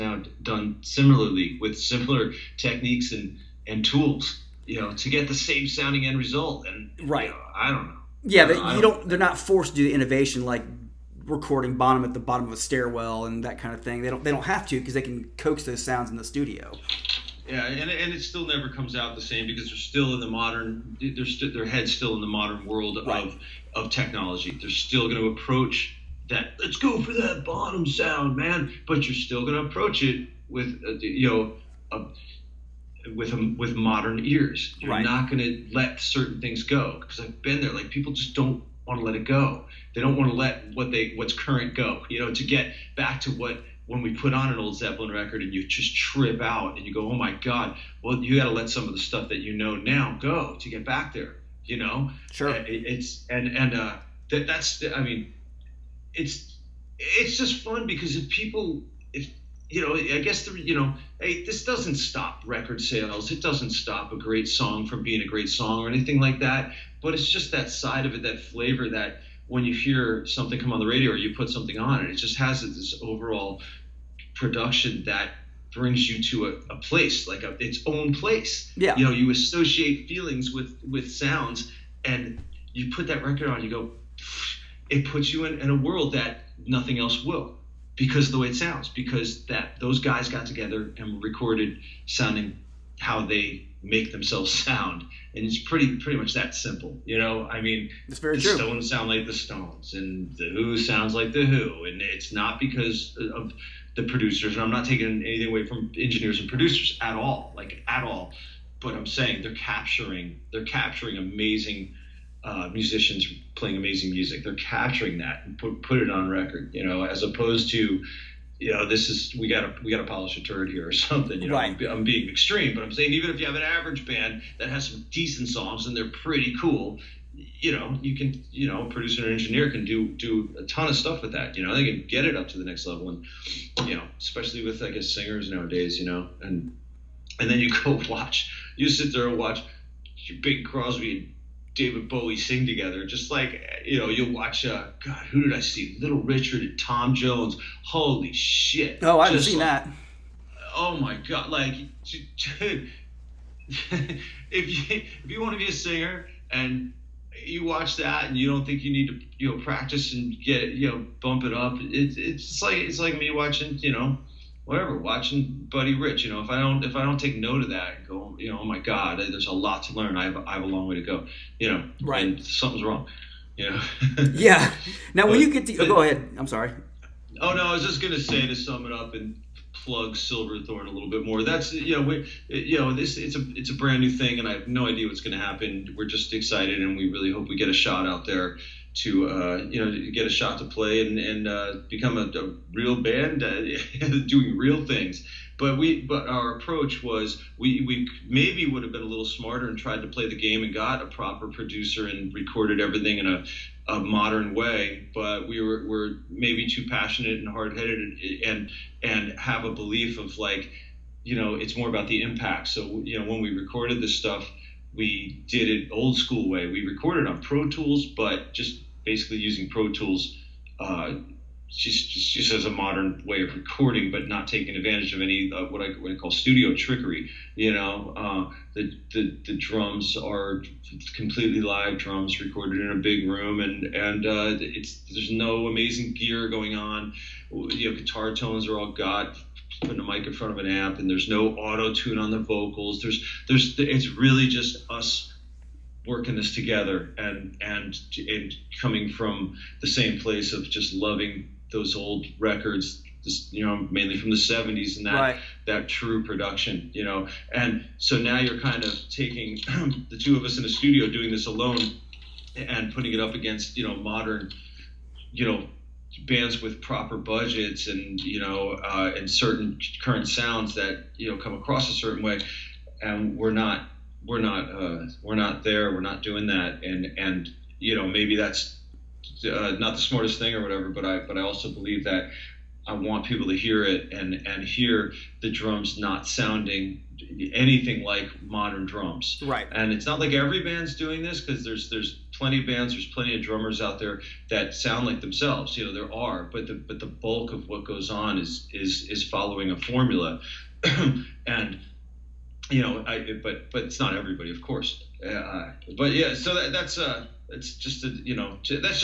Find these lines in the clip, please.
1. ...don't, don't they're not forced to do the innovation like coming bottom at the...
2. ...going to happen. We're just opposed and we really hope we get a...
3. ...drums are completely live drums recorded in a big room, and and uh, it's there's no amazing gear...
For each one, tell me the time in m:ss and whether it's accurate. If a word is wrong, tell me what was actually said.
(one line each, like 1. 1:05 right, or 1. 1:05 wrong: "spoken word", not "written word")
1. 0:08 wrong: "recording", not "coming"
2. 3:05 wrong: "excited", not "opposed"
3. 3:49 right.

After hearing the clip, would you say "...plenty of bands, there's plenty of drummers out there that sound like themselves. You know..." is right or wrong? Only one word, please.
right.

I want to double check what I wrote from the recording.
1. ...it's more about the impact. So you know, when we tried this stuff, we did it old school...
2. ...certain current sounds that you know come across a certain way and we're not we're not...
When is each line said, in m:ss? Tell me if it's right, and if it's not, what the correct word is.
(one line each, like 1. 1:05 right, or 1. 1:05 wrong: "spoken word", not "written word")
1. 3:31 wrong: "recorded", not "tried"
2. 4:29 right.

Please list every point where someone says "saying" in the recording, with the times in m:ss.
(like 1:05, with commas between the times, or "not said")
1:49, 2:02.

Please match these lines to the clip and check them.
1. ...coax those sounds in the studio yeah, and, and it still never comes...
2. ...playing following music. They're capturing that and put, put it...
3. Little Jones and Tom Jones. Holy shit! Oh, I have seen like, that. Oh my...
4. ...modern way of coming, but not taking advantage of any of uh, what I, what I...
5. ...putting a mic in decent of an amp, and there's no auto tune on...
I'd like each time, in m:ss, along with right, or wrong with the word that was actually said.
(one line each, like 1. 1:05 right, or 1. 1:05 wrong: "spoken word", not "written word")
1. 0:15 right
2. 1:53 wrong: "amazing", not "following"
3. 2:25 wrong: "Richard", not "Jones"
4. 3:42 wrong: "recording", not "coming"
5. 3:59 wrong: "front", not "decent".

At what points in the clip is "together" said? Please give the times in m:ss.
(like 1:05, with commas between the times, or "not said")
1:30, 2:22, 4:06.